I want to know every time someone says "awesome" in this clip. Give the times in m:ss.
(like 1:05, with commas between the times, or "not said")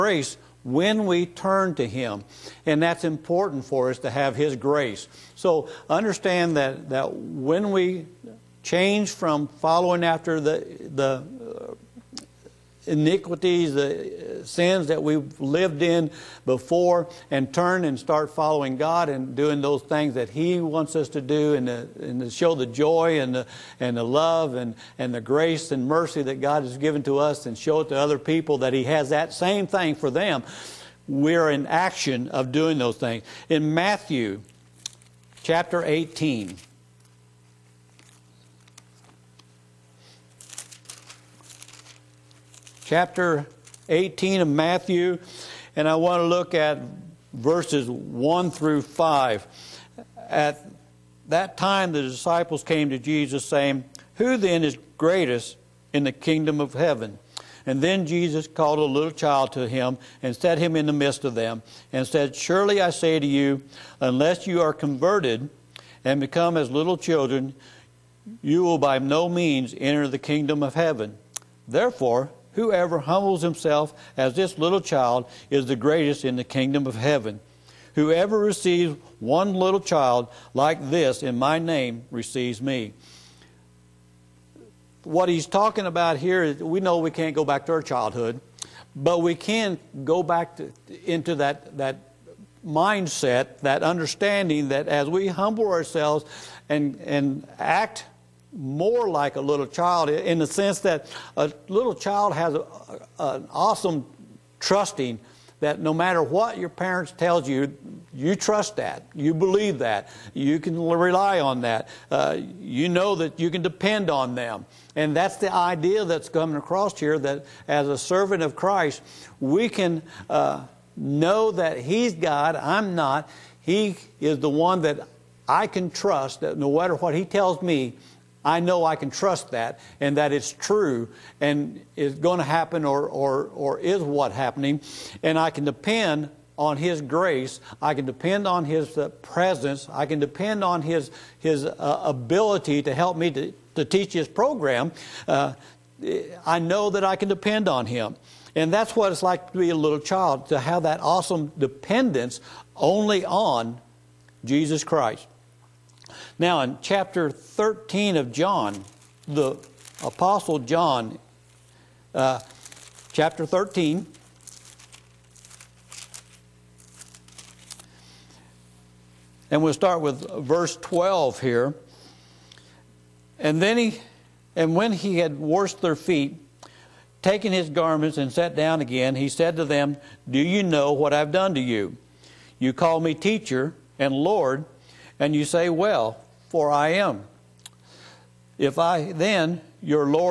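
1:43, 2:31.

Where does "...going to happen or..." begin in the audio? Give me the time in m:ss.
2:12.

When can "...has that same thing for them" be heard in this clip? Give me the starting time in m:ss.
0:28.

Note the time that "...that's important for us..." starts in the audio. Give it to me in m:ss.
0:02.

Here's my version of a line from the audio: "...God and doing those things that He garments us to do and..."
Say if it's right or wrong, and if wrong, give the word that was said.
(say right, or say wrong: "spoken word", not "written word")
wrong: "wants", not "garments".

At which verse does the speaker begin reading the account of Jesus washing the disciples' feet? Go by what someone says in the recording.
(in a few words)
12.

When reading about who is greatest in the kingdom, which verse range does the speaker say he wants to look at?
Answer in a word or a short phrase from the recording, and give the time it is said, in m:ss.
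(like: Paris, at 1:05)
1 through 5, at 0:47.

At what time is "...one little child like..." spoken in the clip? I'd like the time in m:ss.
1:19.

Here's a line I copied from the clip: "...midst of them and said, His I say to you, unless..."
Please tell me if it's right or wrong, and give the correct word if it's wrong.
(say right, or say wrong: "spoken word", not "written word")
wrong: "Surely", not "His".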